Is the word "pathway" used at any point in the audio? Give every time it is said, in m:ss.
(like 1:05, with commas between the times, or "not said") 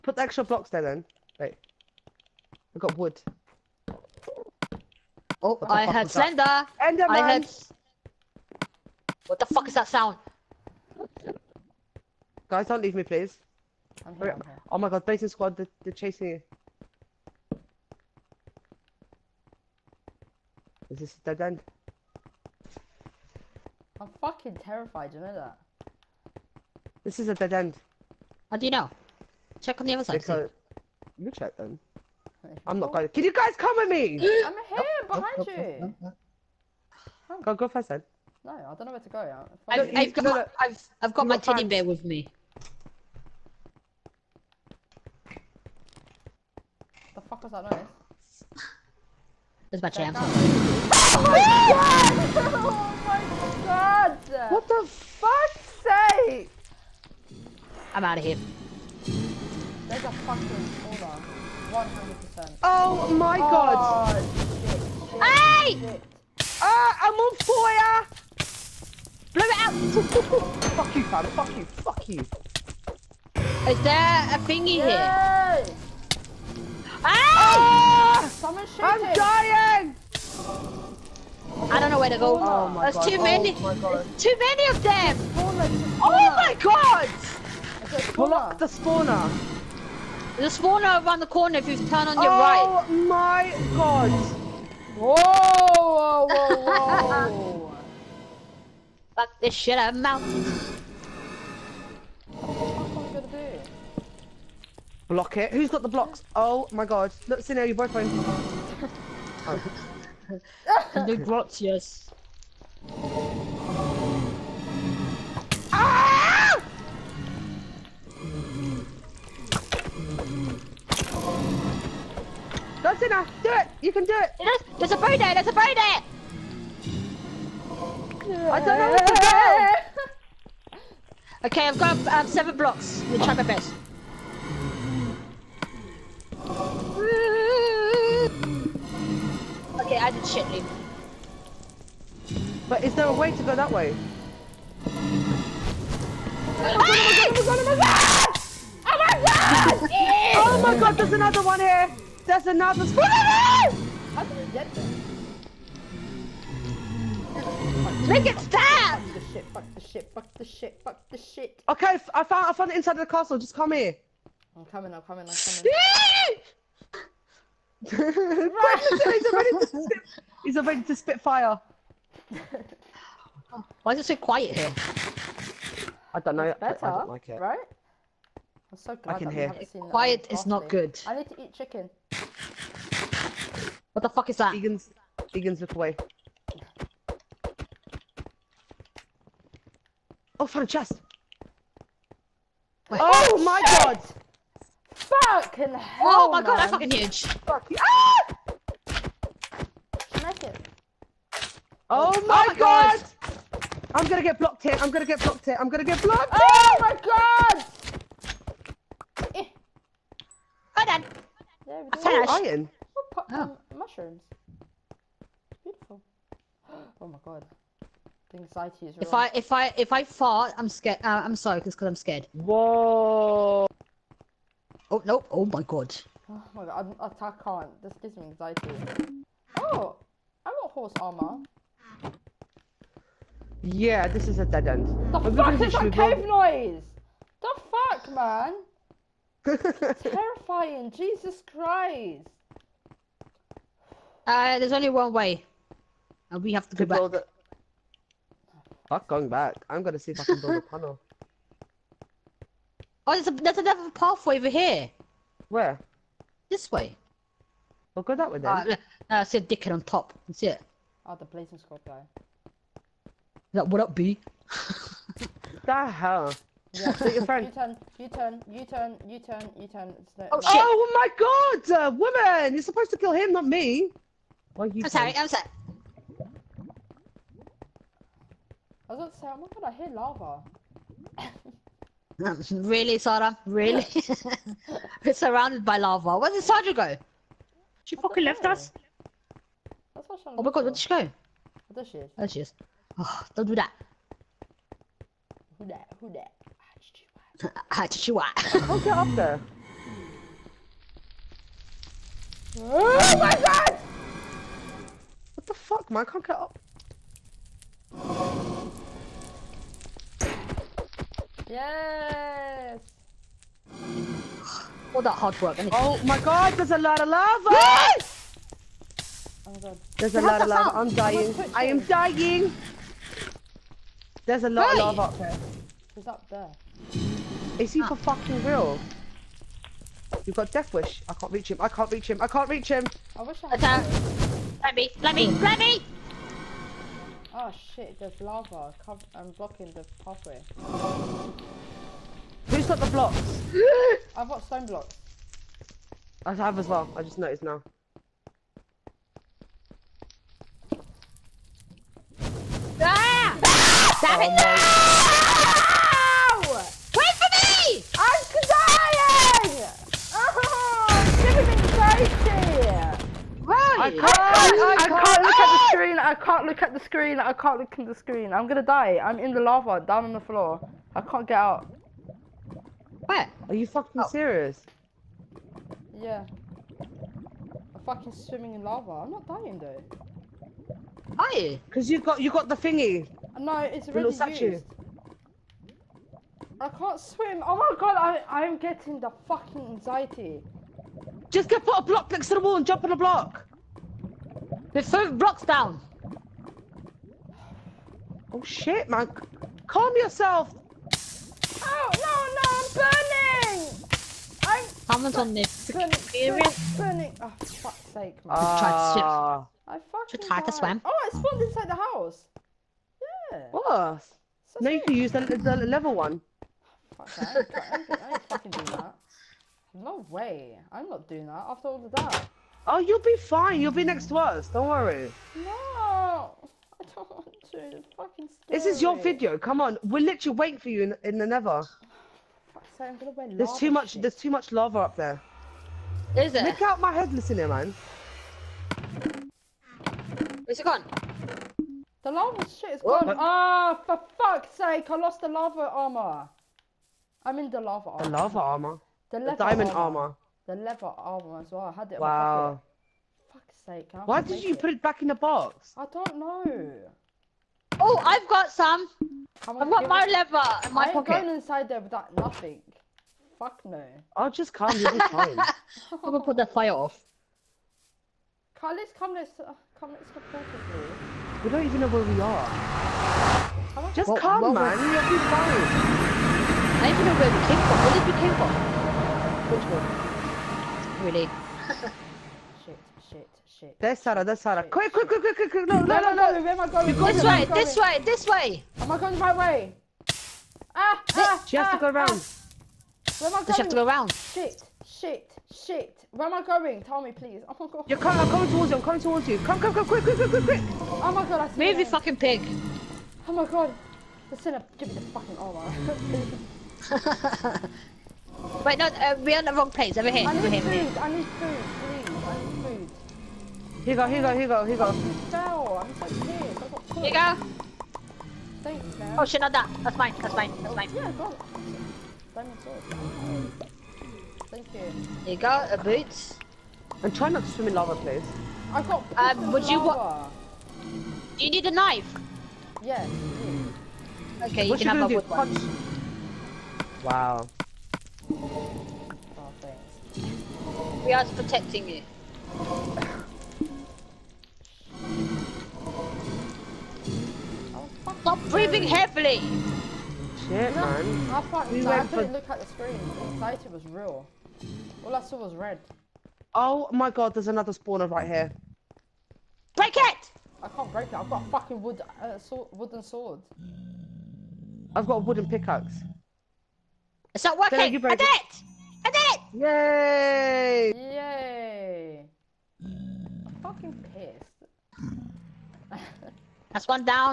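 4:13, 5:40.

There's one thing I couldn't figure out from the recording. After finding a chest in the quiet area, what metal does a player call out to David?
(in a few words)
iron.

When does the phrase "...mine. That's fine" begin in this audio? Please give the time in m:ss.
8:40.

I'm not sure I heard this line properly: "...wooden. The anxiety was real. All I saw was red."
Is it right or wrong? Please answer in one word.
wrong.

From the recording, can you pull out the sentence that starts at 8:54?
Yeah, okay, you can have a wood one.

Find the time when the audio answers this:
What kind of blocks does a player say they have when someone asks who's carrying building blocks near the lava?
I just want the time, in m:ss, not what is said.
5:44.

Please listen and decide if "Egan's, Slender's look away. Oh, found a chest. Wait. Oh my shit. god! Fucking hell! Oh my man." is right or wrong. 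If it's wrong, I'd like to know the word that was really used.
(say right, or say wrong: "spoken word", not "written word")
wrong: "Egan", not "Slender".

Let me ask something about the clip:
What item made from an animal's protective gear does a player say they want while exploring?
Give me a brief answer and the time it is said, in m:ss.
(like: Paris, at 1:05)
horse armor, at 3:50.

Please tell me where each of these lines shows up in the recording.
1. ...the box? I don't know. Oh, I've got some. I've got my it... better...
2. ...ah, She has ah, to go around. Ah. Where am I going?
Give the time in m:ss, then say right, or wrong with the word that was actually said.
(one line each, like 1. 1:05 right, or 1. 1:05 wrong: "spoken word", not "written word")
1. 7:35 wrong: "leather", not "better"
2. 8:11 right.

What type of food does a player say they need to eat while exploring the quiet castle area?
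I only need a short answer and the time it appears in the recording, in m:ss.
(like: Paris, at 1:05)
chicken, at 3:01.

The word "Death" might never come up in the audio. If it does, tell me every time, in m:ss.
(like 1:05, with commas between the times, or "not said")
5:30.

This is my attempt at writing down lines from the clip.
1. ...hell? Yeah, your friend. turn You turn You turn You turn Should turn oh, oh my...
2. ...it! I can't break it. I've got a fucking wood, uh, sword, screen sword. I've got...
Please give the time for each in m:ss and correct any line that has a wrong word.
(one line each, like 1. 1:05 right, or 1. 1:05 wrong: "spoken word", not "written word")
1. 4:25 wrong: "You", not "Should"
2. 9:19 wrong: "wooden", not "screen".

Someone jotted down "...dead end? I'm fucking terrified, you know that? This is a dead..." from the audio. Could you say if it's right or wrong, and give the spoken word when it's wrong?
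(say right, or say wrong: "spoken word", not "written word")
right.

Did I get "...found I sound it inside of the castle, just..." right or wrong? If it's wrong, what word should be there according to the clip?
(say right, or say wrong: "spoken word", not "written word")
wrong: "found", not "sound".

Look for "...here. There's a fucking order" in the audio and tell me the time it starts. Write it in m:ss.
0:58.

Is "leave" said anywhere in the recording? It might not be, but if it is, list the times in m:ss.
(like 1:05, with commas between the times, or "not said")
0:12, 2:20.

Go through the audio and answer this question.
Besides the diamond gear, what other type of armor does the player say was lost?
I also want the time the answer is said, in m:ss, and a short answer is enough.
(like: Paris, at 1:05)
leather armor, at 7:30.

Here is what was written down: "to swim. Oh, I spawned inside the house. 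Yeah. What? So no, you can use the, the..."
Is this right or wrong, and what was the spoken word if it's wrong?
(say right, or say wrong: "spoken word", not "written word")
right.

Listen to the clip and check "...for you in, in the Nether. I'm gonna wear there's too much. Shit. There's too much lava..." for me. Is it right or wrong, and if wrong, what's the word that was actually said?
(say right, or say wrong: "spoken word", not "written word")
right.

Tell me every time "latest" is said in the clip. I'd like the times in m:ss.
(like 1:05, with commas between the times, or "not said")
not said.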